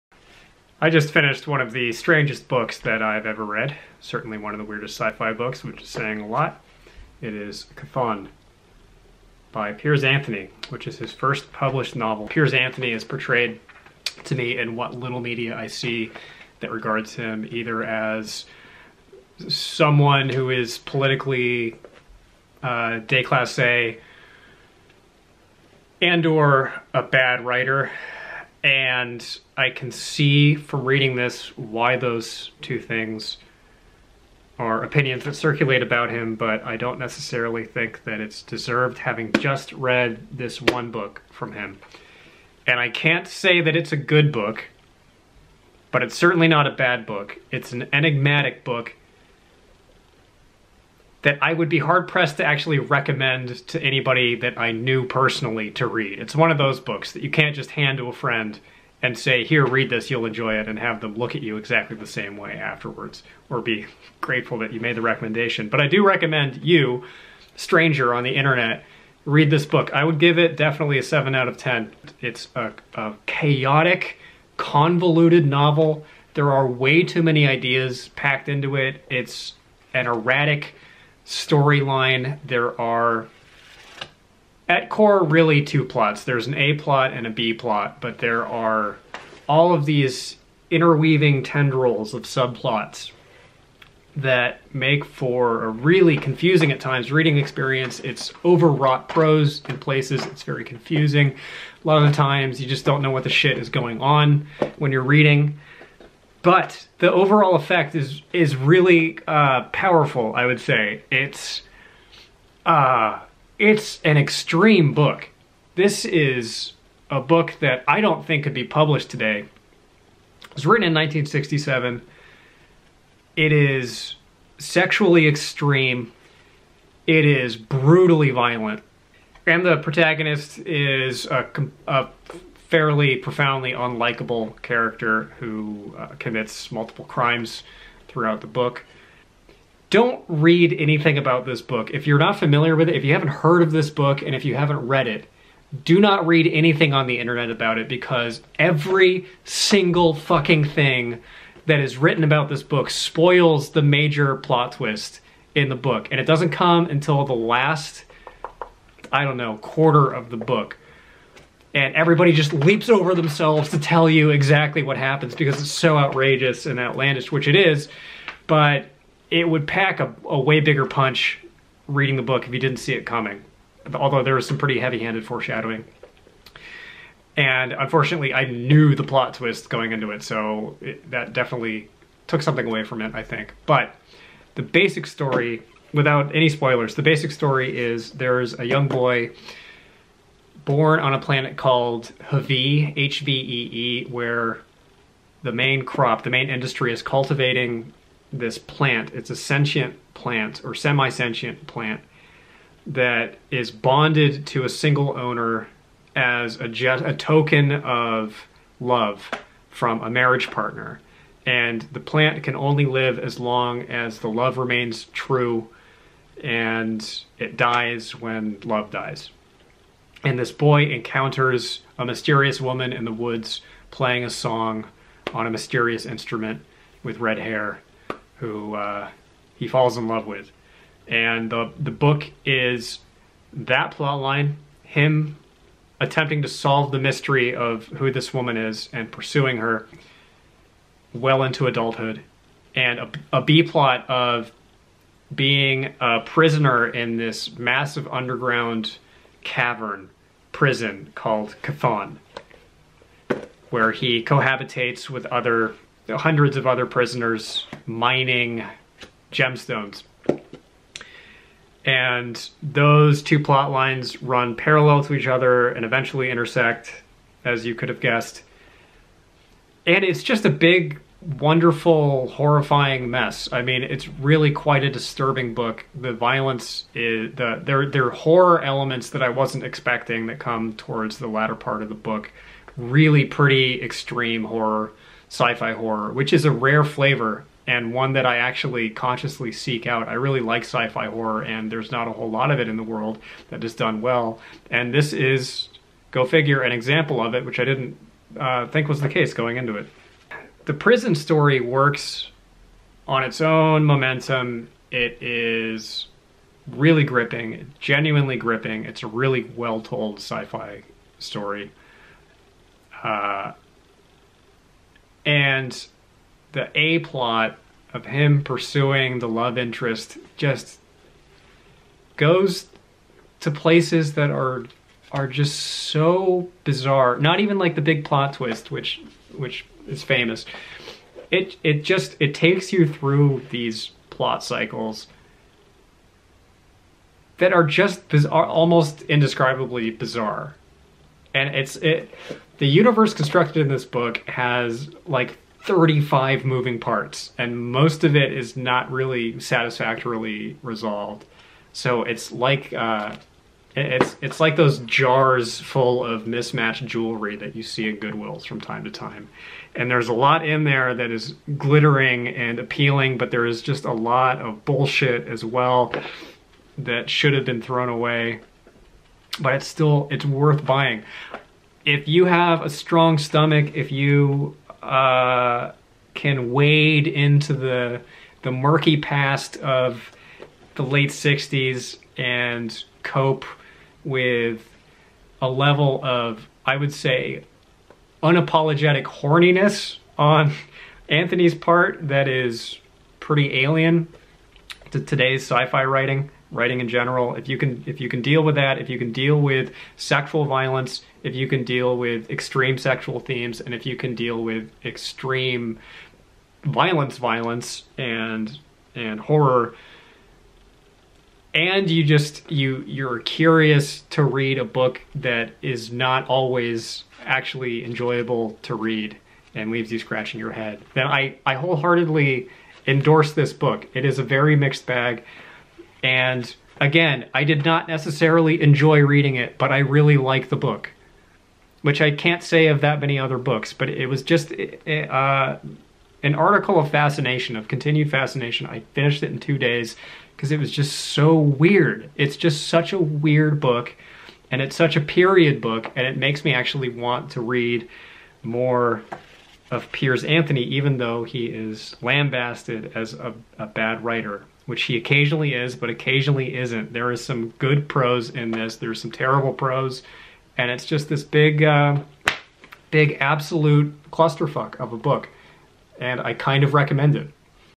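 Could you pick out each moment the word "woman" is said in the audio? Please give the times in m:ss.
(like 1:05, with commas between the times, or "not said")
3:42, 3:58.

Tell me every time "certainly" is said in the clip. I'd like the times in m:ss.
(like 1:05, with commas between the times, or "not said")
0:03, 0:46.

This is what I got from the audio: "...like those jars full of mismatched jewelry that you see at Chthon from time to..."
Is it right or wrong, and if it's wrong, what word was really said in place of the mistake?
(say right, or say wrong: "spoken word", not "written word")
wrong: "Goodwills", not "Chthon".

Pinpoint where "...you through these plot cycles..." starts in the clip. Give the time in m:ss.
5:32.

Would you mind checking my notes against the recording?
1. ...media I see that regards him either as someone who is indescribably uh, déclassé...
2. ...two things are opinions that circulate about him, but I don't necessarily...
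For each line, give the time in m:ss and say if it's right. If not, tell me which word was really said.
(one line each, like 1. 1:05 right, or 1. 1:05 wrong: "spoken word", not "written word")
1. 0:15 wrong: "politically", not "indescribably"
2. 0:32 right.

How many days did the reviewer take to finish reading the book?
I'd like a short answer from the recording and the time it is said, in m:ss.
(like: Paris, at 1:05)
2, at 7:19.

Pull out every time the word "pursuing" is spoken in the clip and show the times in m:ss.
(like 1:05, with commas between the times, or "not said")
3:59, 5:18.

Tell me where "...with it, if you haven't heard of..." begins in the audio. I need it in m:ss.
2:22.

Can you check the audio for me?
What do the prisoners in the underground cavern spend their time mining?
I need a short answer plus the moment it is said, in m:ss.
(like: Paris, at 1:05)
Gemstones, at 4:19.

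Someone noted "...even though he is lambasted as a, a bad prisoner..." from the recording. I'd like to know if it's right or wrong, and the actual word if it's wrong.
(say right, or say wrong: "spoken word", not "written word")
wrong: "writer", not "prisoner".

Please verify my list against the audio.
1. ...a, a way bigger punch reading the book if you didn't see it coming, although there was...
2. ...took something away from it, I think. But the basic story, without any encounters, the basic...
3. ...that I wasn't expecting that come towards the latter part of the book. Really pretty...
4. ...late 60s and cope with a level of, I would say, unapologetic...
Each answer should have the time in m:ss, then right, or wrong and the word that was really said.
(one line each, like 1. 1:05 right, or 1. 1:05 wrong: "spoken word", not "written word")
1. 2:50 right
2. 3:02 wrong: "spoilers", not "encounters"
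3. 4:39 right
4. 6:20 right.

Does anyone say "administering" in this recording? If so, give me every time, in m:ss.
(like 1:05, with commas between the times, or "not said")
not said.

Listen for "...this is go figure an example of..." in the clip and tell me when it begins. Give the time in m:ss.
4:54.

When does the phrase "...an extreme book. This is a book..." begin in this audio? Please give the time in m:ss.
1:54.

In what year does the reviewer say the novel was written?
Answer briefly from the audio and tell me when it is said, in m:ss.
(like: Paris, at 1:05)
1967, at 2:00.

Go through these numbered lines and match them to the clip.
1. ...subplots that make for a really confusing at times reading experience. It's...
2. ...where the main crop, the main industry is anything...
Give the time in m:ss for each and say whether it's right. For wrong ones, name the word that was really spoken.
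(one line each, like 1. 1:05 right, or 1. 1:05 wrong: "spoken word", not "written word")
1. 1:32 right
2. 3:14 wrong: "cultivating", not "anything".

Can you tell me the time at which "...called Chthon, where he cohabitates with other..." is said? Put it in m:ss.
4:11.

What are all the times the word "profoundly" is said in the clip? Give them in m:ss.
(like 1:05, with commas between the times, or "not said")
2:13.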